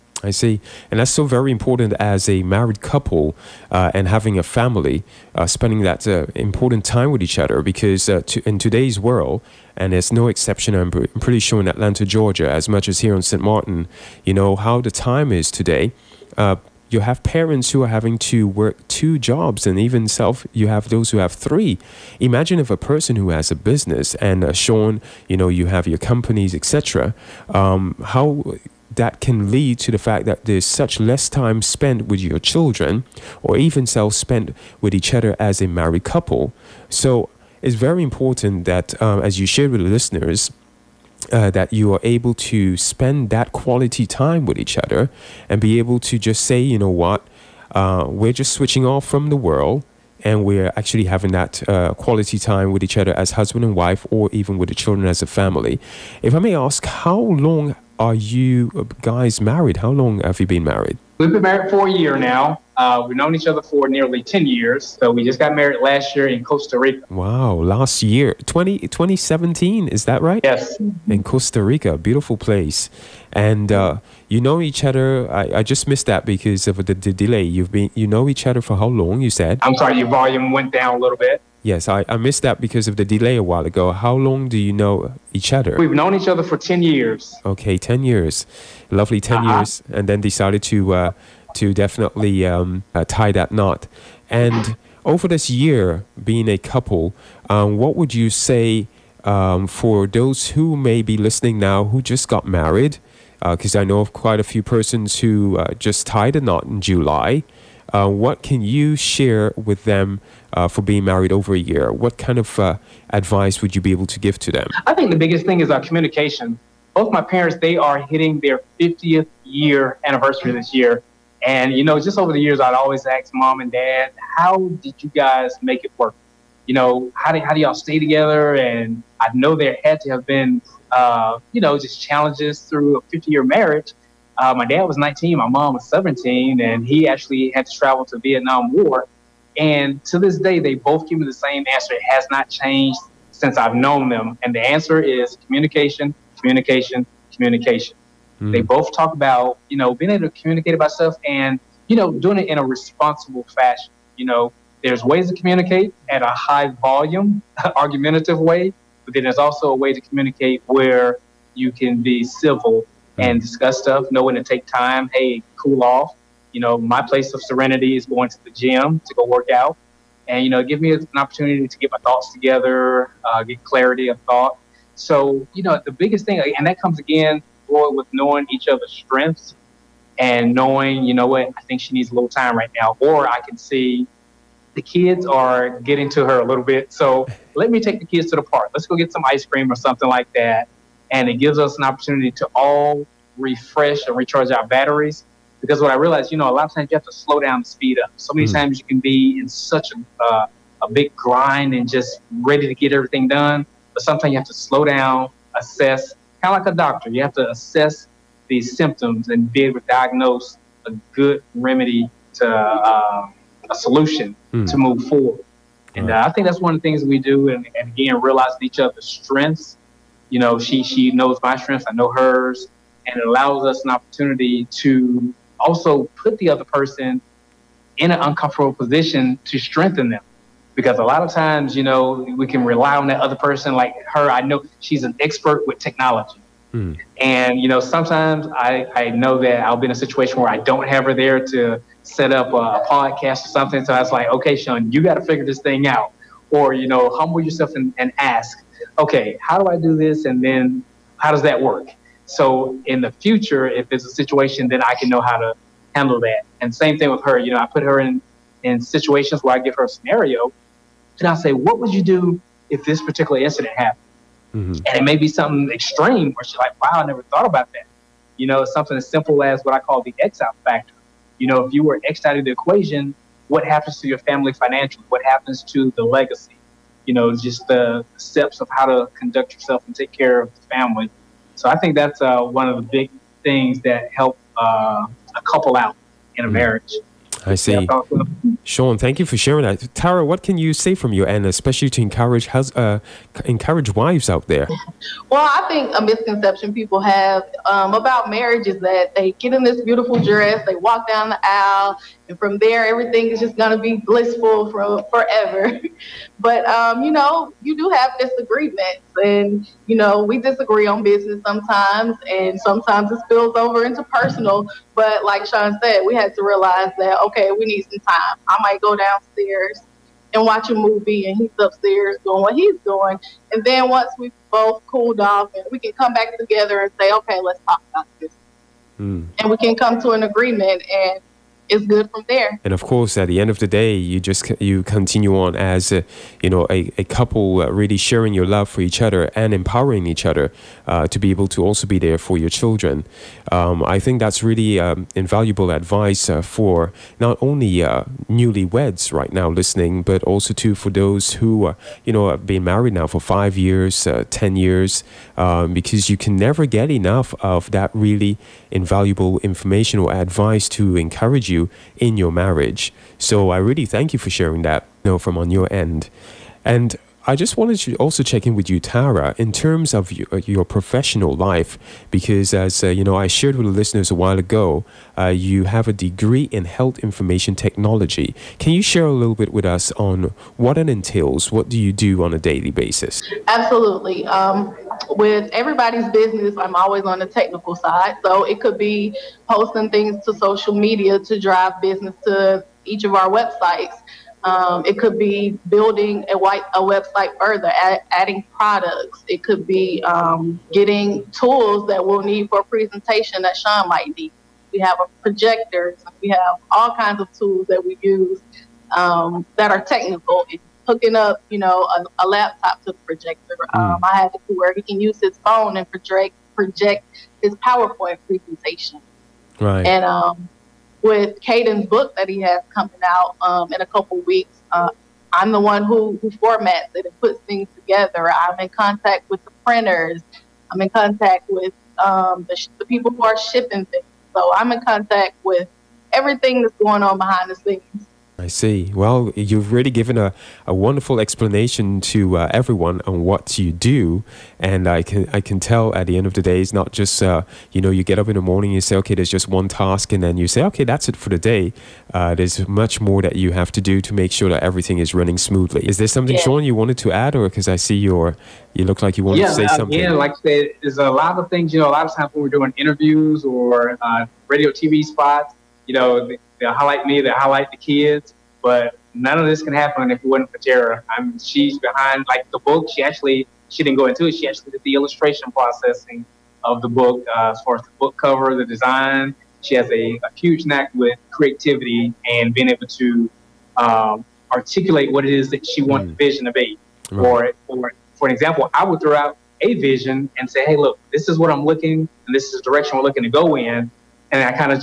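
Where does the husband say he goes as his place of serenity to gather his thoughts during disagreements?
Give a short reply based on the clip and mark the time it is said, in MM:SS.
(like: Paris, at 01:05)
the gym, at 02:48.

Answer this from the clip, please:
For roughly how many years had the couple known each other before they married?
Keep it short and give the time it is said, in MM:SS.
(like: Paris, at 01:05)
10 years, at 01:03.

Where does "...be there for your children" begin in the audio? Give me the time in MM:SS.
05:41.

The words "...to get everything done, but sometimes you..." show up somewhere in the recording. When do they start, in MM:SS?
03:22.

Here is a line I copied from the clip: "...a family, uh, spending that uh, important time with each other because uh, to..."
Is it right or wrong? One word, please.
right.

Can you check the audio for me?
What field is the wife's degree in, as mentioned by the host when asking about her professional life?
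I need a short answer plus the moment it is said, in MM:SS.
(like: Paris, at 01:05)
health information technology, at 06:16.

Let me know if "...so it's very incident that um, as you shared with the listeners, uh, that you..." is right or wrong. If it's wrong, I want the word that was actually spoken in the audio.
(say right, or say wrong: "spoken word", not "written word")
wrong: "important", not "incident".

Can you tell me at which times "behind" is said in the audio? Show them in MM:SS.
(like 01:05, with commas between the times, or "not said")
07:17, 07:51.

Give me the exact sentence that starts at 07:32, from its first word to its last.
Uh, there's much more that you have to do to make sure that everything is running smoothly.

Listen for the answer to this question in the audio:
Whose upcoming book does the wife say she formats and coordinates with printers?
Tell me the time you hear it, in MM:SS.
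07:01.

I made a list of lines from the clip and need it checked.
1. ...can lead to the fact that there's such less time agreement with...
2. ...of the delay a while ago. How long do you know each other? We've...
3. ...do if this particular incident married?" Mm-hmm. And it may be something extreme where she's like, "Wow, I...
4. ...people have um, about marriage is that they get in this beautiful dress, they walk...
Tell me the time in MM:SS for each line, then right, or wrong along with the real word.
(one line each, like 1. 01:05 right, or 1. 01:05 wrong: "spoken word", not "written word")
1. 00:29 wrong: "spent", not "agreement"
2. 01:22 right
3. 04:22 wrong: "happened", not "married"
4. 04:56 right.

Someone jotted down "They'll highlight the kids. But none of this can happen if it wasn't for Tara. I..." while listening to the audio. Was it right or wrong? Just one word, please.
right.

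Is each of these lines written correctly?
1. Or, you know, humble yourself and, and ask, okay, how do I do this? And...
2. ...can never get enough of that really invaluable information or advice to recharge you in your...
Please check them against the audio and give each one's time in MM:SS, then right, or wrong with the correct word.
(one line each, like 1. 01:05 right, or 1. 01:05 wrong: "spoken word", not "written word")
1. 04:06 right
2. 05:56 wrong: "encourage", not "recharge".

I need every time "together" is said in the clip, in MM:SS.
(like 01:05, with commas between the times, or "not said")
02:07, 02:52, 05:26, 07:07.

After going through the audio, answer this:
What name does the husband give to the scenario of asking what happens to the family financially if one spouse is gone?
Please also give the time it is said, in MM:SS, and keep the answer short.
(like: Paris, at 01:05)
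the X out factor, at 04:30.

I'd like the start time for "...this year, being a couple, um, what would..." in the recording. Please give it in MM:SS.
01:35.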